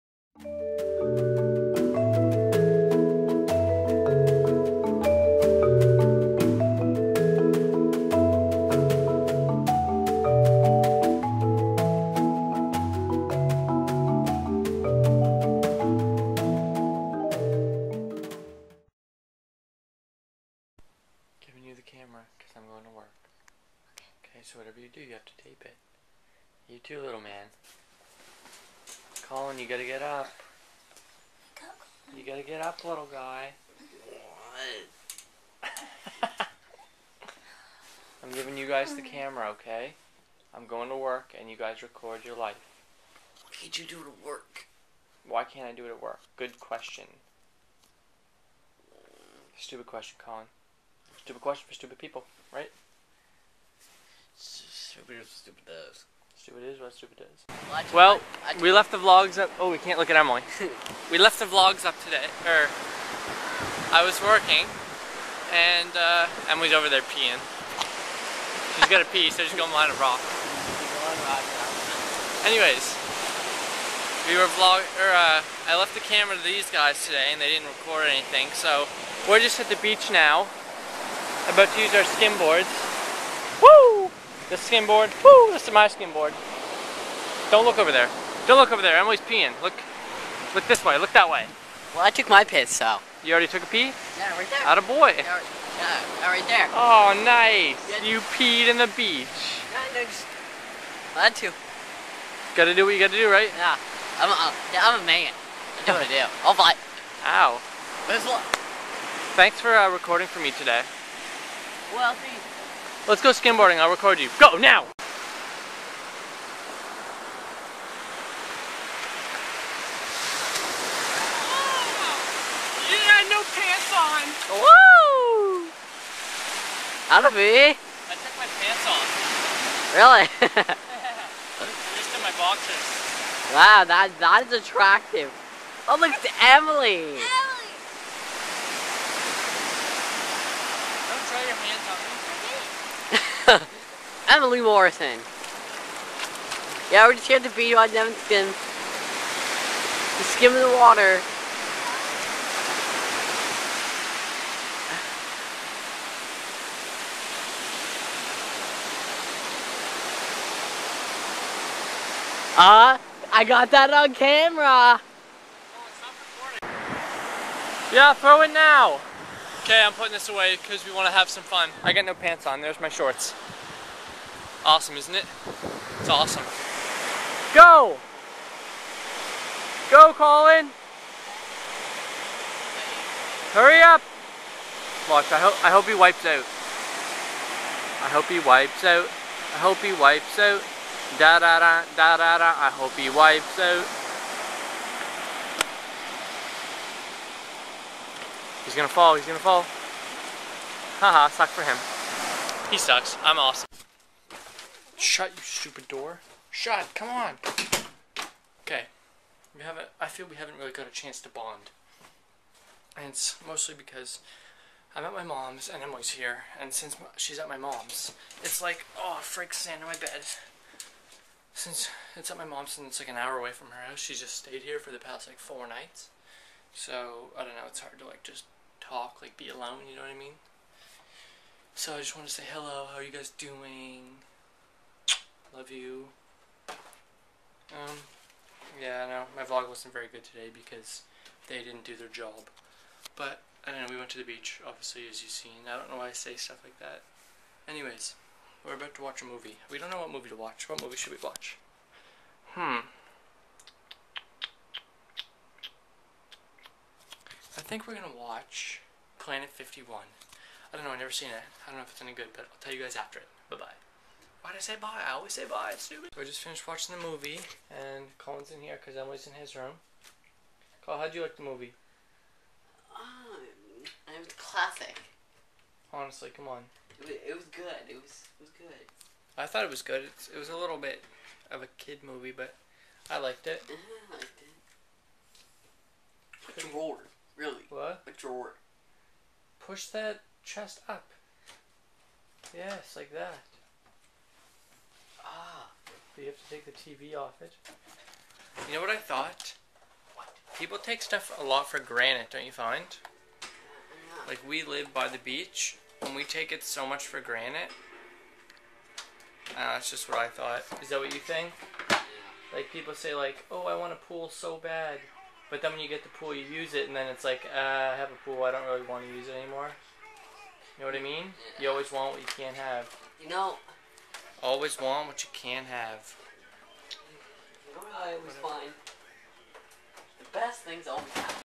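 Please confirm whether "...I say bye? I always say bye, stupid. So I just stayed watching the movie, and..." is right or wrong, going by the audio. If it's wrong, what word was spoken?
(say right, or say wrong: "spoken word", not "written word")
wrong: "finished", not "stayed".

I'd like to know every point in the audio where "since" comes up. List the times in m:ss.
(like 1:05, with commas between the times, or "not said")
3:36, 3:41.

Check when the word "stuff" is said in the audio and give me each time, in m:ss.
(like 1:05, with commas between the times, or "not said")
4:06, 5:01.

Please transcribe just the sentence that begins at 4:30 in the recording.
Colin, how'd you like the movie?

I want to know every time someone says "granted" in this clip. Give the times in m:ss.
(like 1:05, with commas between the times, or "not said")
5:01, 5:07.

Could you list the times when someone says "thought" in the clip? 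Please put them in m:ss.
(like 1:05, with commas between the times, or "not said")
4:39, 4:58, 5:10.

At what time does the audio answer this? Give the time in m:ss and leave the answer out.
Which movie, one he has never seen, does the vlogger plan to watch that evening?
4:19.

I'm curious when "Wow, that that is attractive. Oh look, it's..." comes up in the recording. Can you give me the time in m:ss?
2:13.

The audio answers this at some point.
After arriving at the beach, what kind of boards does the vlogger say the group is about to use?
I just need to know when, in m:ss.
1:22.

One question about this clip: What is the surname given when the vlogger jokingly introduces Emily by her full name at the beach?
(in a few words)
Morrison.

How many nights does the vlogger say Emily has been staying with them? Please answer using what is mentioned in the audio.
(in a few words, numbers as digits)
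4.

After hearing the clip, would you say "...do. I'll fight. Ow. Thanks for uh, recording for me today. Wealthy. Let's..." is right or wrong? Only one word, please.
right.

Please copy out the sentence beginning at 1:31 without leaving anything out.
Well, I took my piss, so.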